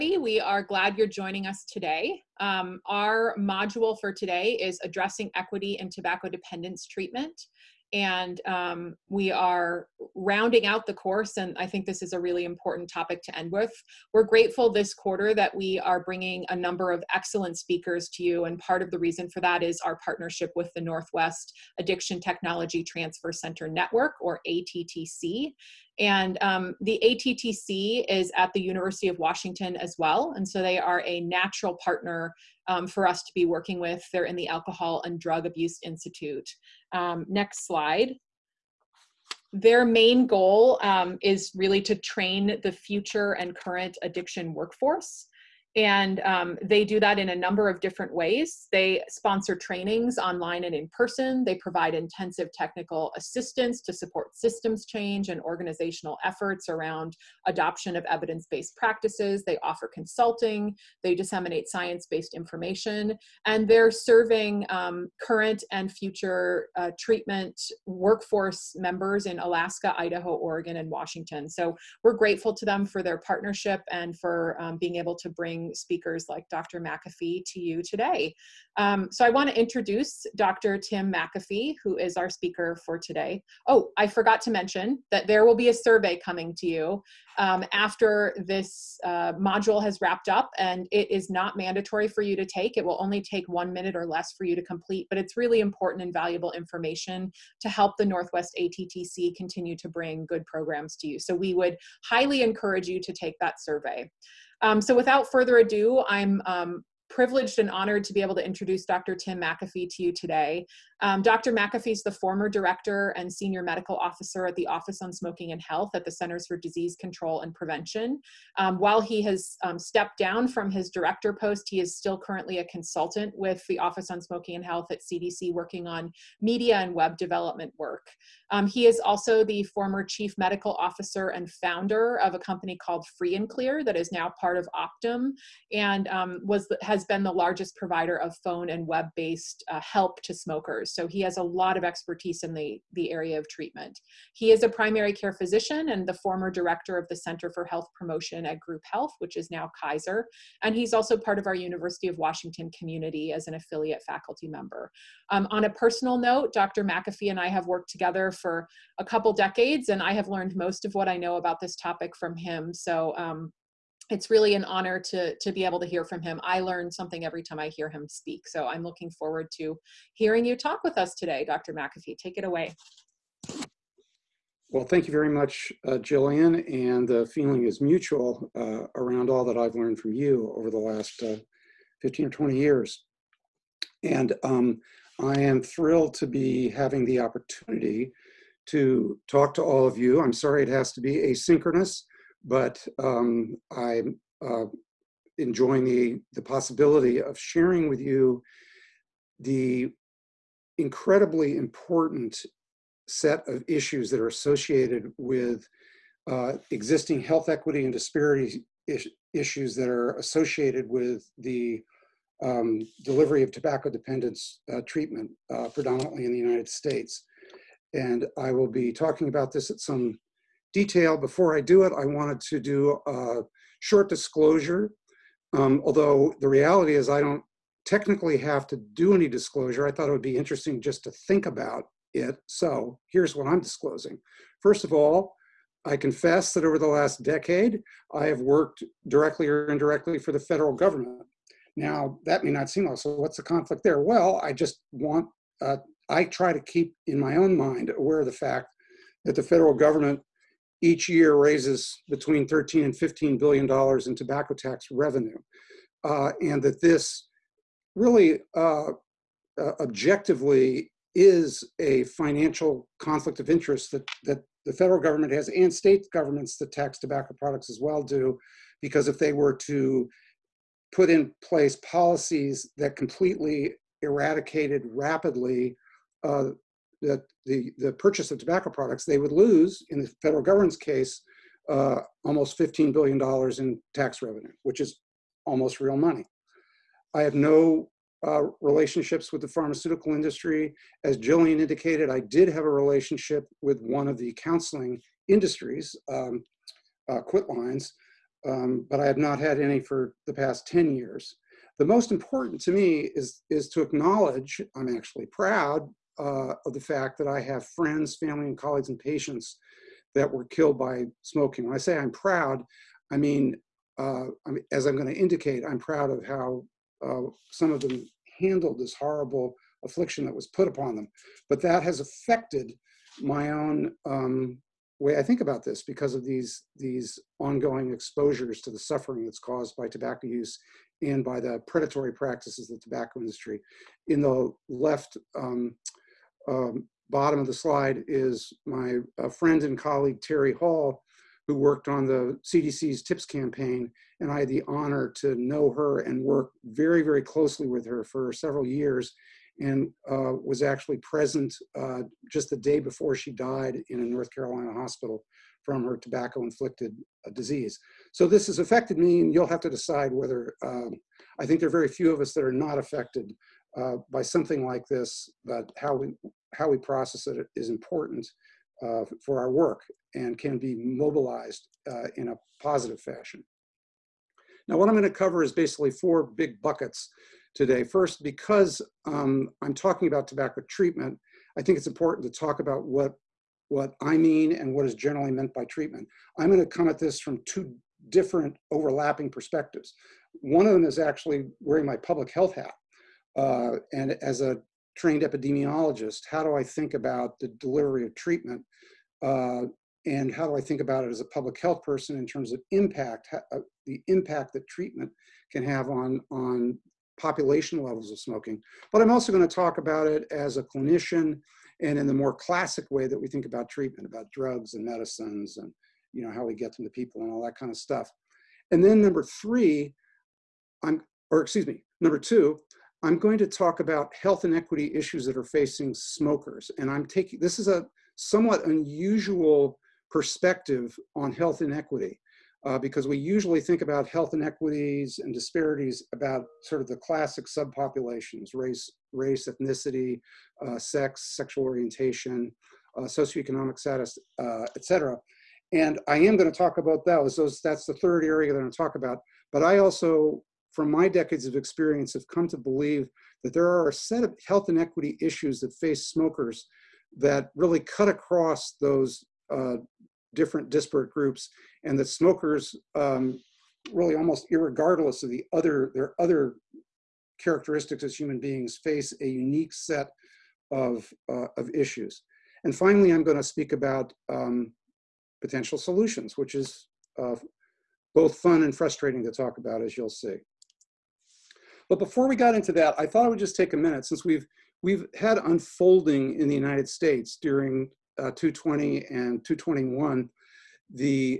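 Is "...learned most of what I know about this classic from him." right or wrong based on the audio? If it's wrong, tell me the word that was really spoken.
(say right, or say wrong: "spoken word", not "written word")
wrong: "topic", not "classic".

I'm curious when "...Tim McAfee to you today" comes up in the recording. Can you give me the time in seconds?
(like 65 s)
109 s.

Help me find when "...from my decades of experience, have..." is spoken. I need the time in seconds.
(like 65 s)
450 s.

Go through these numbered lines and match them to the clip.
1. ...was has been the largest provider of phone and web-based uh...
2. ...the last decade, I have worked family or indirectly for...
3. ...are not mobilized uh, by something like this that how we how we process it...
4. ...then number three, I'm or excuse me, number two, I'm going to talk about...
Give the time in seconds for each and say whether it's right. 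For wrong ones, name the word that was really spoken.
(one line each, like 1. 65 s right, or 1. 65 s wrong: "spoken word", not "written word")
1. 136 s right
2. 236 s wrong: "directly", not "family"
3. 362 s wrong: "affected", not "mobilized"
4. 418 s right.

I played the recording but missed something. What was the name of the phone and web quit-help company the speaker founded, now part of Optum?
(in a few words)
Free and Clear.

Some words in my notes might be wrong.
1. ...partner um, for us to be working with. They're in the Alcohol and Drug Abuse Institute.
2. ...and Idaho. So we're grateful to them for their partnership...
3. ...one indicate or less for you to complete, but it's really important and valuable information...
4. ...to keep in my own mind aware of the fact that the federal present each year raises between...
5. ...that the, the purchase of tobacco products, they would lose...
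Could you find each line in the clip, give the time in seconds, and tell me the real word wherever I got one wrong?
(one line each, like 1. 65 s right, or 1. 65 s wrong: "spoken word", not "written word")
1. 31 s right
2. 70 s wrong: "Washington", not "Idaho"
3. 93 s wrong: "minute", not "indicate"
4. 246 s wrong: "government", not "present"
5. 277 s right.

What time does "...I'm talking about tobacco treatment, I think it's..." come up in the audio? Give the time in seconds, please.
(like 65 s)
379 s.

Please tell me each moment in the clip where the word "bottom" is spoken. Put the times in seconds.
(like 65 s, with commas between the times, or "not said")
337 s.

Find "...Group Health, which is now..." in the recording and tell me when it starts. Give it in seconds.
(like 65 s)
148 s.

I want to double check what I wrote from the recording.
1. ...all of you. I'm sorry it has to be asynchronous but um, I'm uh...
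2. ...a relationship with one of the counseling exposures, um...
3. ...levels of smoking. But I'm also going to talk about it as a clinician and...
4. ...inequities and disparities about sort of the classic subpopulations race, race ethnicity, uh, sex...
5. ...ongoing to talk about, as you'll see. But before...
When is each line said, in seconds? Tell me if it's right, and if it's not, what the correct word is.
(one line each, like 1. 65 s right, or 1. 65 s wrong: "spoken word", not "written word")
1. 189 s right
2. 292 s wrong: "industries", not "exposures"
3. 407 s right
4. 434 s right
5. 478 s wrong: "frustrating", not "ongoing".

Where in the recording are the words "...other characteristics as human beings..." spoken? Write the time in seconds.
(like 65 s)
466 s.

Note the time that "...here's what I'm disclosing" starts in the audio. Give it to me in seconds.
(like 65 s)
233 s.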